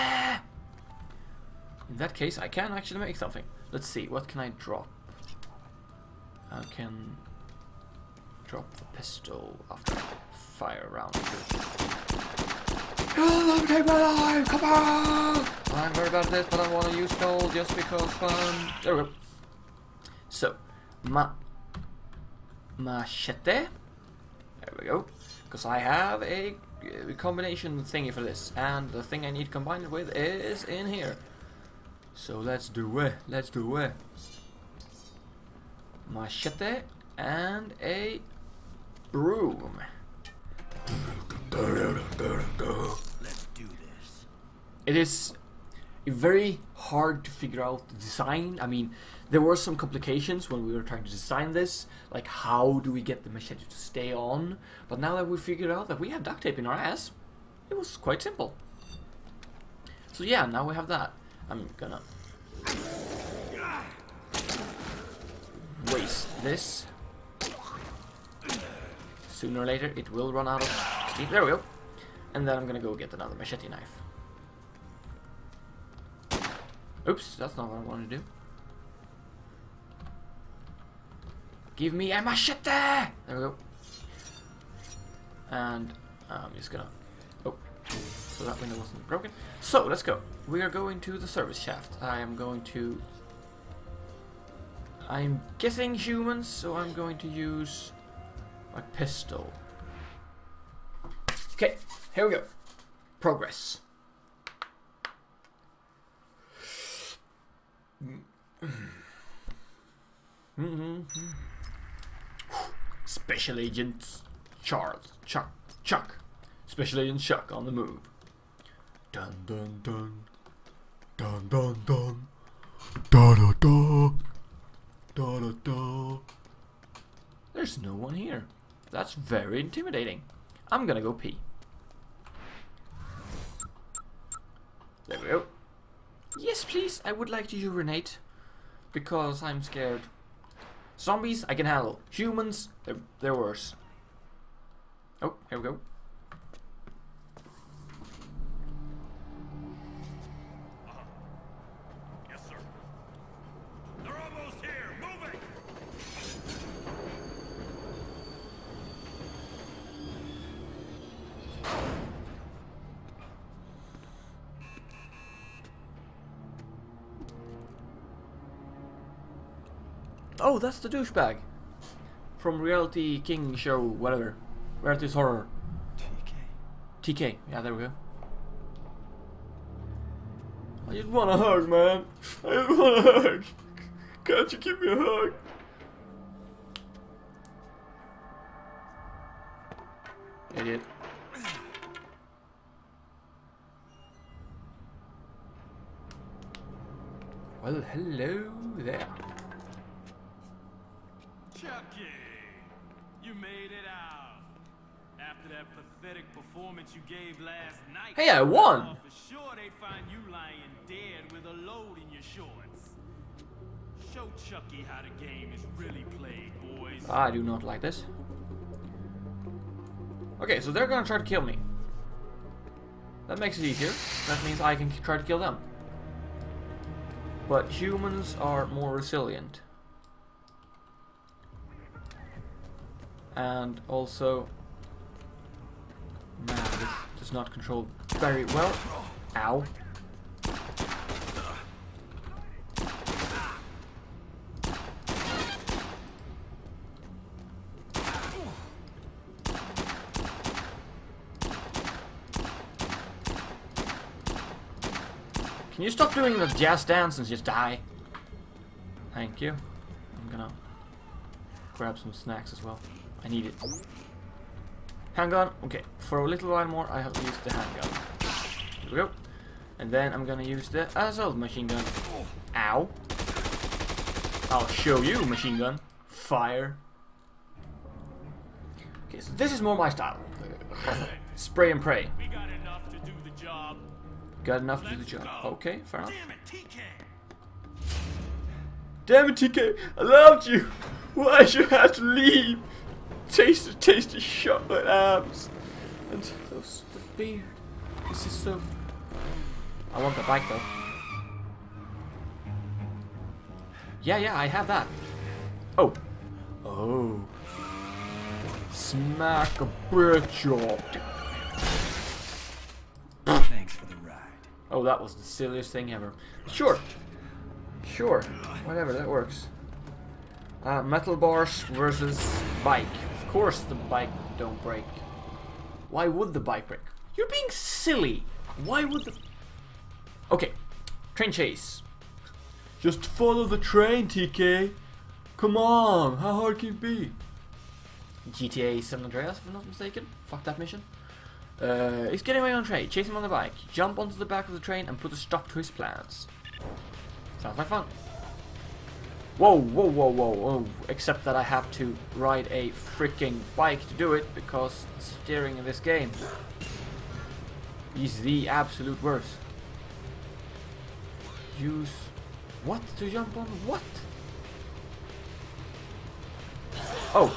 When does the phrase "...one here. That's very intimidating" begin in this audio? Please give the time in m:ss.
2:08.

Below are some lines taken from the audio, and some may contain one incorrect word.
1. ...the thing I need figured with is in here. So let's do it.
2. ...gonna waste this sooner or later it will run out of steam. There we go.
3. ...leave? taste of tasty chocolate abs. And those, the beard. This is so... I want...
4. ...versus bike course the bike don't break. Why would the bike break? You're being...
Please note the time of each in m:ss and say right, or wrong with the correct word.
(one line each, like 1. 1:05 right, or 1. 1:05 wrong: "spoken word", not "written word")
1. 0:28 wrong: "combined", not "figured"
2. 1:01 right
3. 4:52 right
4. 5:21 right.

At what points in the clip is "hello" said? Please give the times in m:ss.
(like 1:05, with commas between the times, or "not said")
3:17.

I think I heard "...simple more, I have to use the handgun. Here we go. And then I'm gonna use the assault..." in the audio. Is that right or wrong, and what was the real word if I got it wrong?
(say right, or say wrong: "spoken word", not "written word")
wrong: "while", not "simple".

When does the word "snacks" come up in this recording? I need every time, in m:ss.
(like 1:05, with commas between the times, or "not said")
4:22.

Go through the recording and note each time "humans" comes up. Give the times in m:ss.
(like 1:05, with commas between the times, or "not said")
1:35, 2:22.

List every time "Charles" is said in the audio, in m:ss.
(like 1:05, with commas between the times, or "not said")
1:54.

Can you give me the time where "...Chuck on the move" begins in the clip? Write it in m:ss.
1:57.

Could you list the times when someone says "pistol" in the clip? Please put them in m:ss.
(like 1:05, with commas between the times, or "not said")
0:08, 1:38.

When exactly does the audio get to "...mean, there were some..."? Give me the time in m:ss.
0:48.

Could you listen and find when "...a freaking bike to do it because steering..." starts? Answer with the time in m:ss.
5:52.